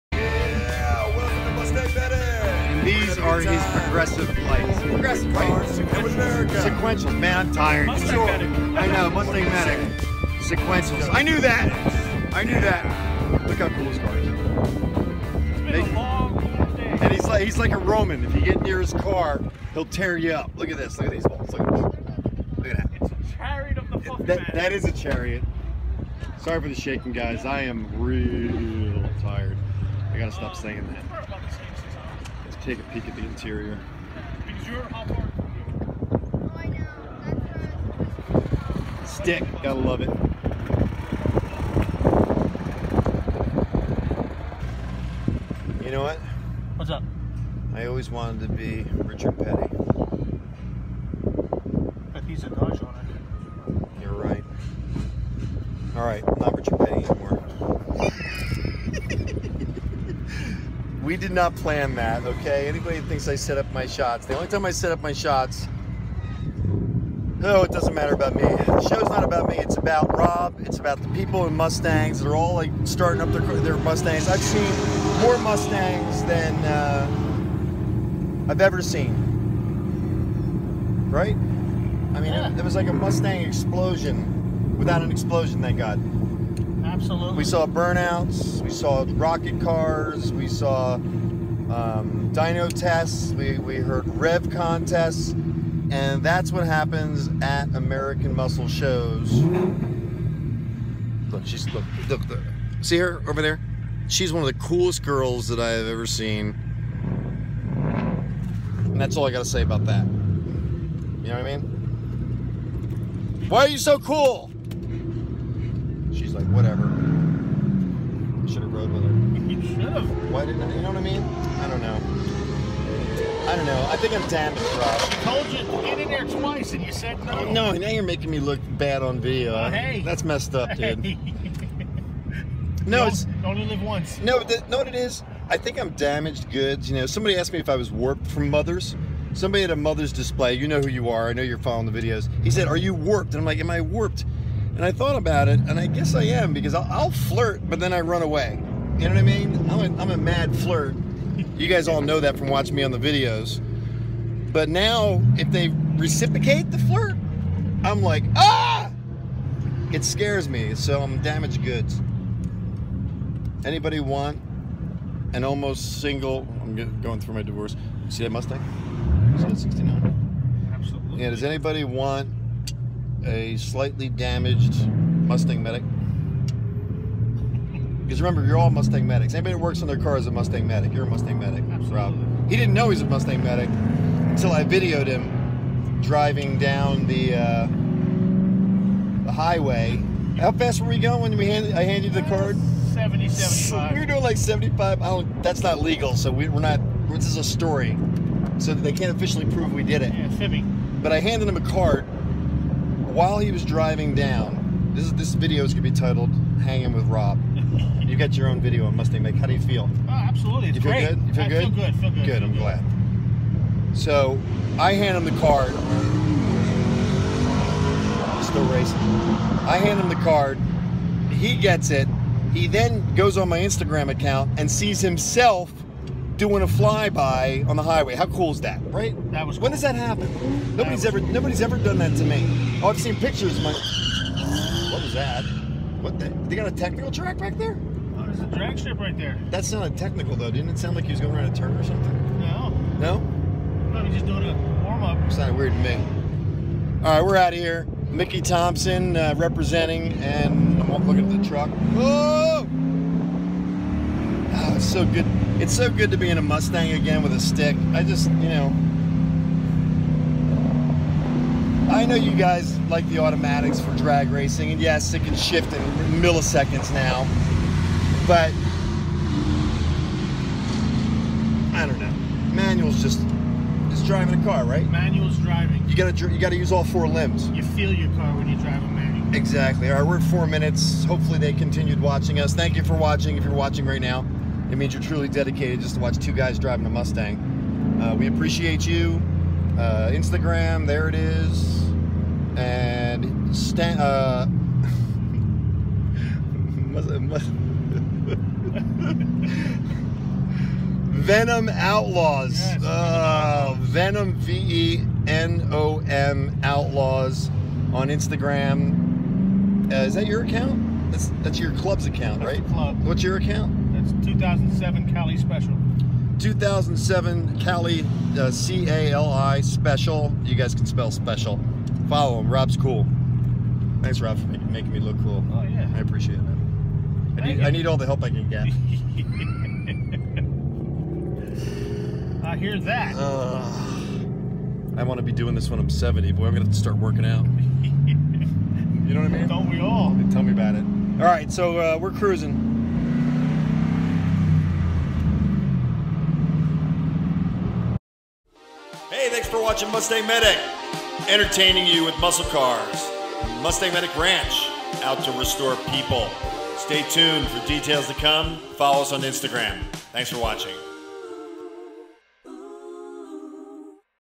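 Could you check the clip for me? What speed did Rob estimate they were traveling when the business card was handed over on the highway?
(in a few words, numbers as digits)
70, 75.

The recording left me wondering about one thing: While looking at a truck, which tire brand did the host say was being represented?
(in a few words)
Mickey Thompson.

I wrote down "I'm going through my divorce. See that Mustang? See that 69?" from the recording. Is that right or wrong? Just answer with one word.
right.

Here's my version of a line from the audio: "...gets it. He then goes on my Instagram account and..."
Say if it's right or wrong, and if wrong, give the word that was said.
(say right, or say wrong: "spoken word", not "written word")
right.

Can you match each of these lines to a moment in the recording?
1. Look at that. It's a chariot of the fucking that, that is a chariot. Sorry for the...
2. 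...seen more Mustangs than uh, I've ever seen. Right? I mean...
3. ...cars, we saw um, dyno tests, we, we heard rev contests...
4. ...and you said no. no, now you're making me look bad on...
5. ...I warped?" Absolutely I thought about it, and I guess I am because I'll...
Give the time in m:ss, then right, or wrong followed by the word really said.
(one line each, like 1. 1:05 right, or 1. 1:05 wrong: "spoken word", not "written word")
1. 0:22 right
2. 1:14 right
3. 1:29 right
4. 2:06 right
5. 2:23 wrong: "And", not "Absolutely".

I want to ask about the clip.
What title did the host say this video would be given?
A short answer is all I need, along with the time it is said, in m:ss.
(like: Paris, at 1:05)
Hanging with Rob, at 3:26.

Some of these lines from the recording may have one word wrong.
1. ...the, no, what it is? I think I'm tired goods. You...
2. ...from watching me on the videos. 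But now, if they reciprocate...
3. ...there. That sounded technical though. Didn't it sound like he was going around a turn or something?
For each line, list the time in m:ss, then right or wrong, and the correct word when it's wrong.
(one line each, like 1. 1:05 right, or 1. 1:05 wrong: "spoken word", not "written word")
1. 2:14 wrong: "damaged", not "tired"
2. 2:32 right
3. 3:59 right.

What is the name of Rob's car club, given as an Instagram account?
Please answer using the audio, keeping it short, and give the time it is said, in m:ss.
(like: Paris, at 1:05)
Venom Outlaws, at 5:01.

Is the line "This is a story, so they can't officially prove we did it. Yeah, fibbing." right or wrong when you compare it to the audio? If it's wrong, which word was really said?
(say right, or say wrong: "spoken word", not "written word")
right.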